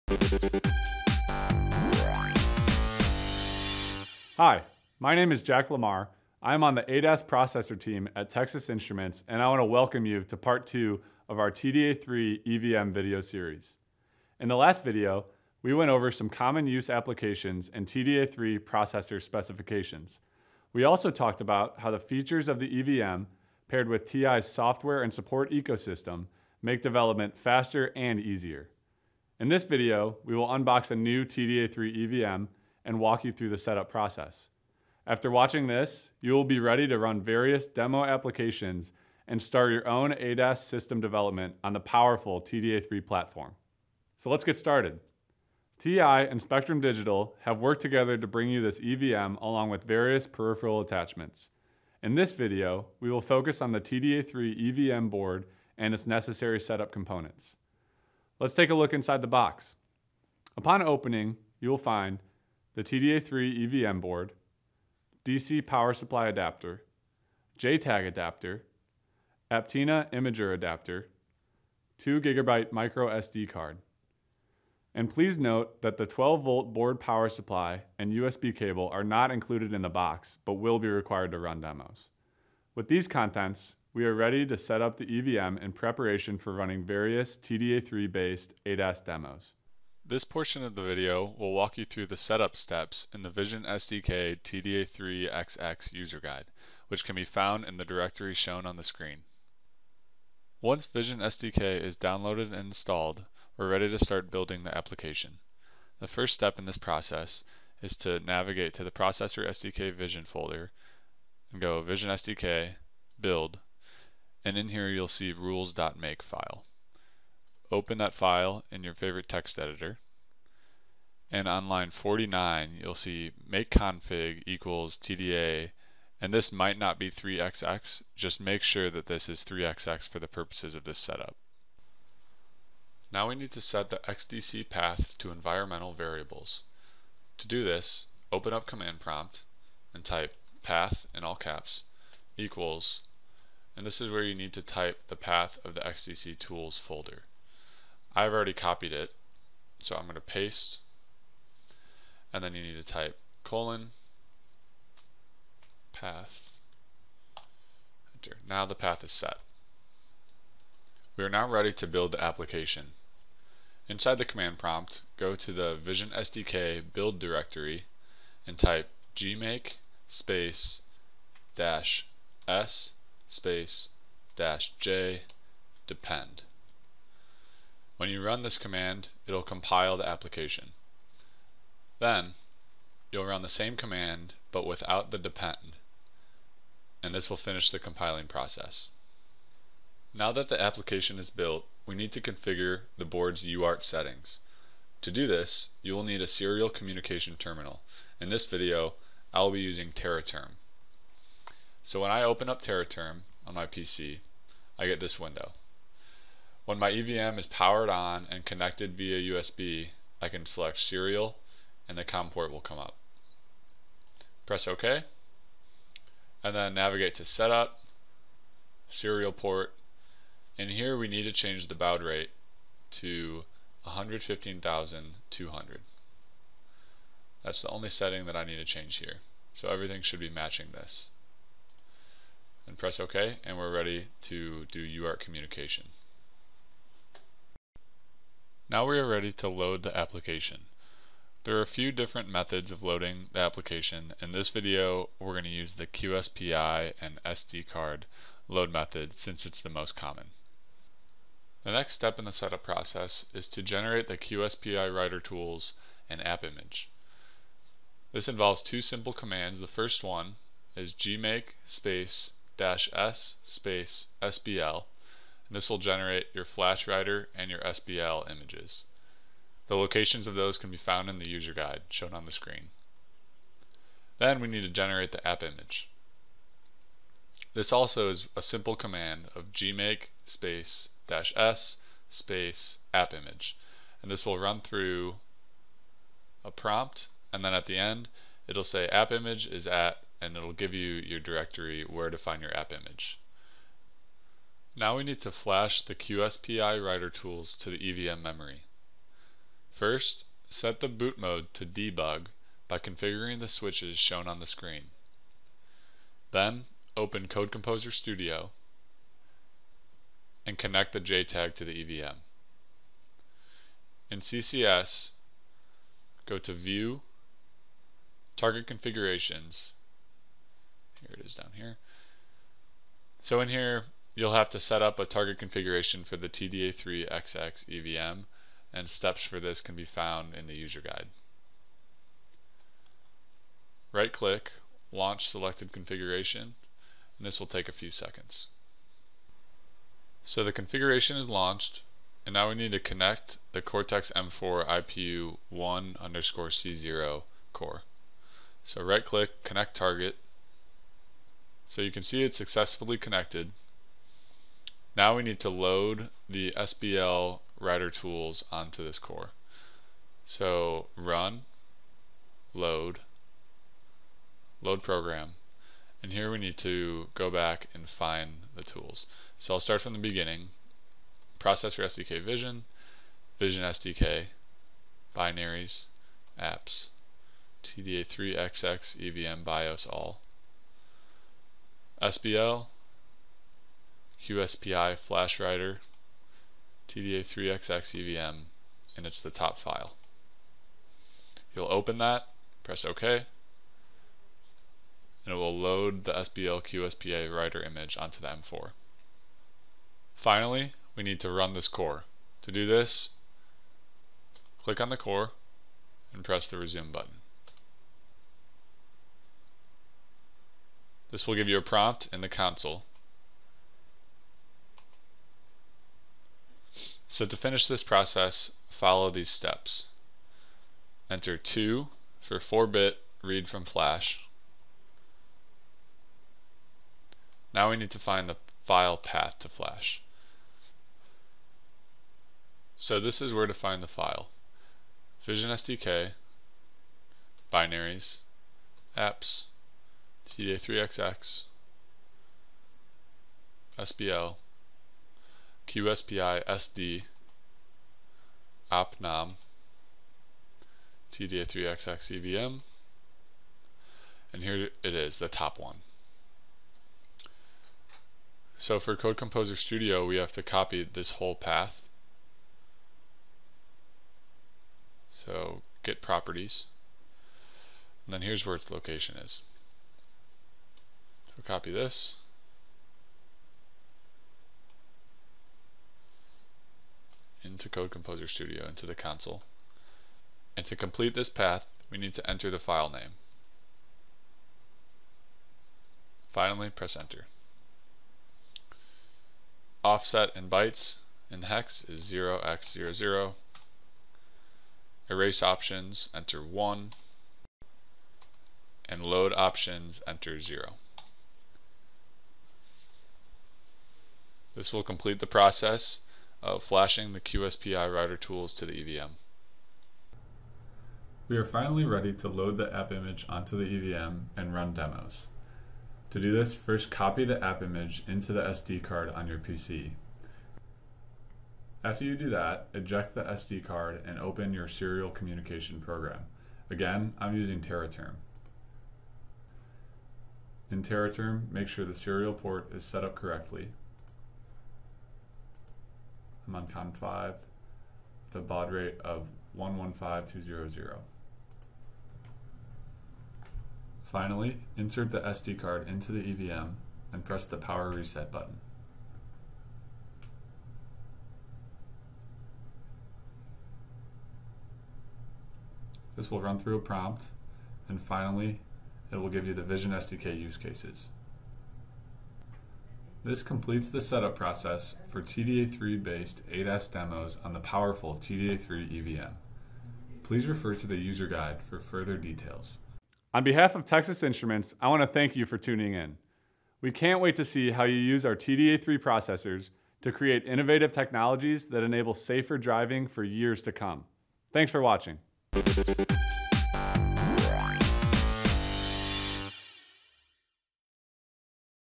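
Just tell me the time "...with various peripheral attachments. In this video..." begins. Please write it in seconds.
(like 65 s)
49 s.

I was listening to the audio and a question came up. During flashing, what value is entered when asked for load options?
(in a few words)
0.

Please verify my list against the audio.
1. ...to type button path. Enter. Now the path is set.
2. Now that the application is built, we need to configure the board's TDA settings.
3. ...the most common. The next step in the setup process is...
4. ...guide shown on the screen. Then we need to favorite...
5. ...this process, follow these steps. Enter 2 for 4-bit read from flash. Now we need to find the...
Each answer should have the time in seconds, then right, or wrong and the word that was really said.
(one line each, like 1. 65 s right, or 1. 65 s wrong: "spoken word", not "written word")
1. 152 s wrong: "colon", not "button"
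2. 190 s wrong: "UART", not "TDA"
3. 249 s right
4. 271 s wrong: "generate", not "favorite"
5. 417 s right.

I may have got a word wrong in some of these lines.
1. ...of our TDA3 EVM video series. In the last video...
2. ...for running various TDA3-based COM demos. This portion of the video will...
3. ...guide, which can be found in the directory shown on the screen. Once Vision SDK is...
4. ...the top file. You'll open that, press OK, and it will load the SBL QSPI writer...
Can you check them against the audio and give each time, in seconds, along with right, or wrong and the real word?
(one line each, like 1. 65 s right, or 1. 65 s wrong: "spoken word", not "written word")
1. 11 s right
2. 86 s wrong: "ADAS", not "COM"
3. 96 s right
4. 389 s right.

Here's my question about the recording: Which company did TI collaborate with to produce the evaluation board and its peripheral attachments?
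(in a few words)
Spectrum Digital.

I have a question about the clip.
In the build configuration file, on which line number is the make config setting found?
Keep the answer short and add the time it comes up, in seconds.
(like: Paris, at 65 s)
49, at 121 s.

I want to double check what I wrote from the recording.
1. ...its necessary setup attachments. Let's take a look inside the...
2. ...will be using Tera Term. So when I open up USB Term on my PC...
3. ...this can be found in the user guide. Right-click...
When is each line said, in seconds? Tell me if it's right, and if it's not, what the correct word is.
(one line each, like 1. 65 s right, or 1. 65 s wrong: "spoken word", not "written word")
1. 55 s wrong: "components", not "attachments"
2. 199 s wrong: "Tera", not "USB"
3. 329 s right.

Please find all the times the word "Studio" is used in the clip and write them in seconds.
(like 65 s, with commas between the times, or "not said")
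307 s, 459 s, 478 s.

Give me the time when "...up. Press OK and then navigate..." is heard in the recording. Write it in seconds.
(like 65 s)
212 s.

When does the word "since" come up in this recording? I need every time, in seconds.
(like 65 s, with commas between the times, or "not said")
249 s.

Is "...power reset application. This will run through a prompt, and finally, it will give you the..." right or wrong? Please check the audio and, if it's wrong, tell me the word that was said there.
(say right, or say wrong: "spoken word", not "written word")
wrong: "button", not "application".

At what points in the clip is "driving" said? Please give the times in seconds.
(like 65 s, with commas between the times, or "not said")
582 s.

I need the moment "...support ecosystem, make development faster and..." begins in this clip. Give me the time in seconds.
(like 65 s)
25 s.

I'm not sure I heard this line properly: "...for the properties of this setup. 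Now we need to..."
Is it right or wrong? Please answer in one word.
wrong.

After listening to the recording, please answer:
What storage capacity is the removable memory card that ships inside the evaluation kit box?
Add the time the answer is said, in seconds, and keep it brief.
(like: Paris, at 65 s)
2 gigabyte, at 71 s.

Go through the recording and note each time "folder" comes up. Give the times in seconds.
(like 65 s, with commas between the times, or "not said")
110 s, 146 s.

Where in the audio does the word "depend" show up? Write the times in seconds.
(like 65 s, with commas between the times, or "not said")
175 s, 185 s.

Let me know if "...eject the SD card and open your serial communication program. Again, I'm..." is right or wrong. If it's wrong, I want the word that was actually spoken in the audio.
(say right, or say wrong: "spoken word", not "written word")
right.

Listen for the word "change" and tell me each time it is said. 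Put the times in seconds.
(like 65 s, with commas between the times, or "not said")
221 s, 228 s.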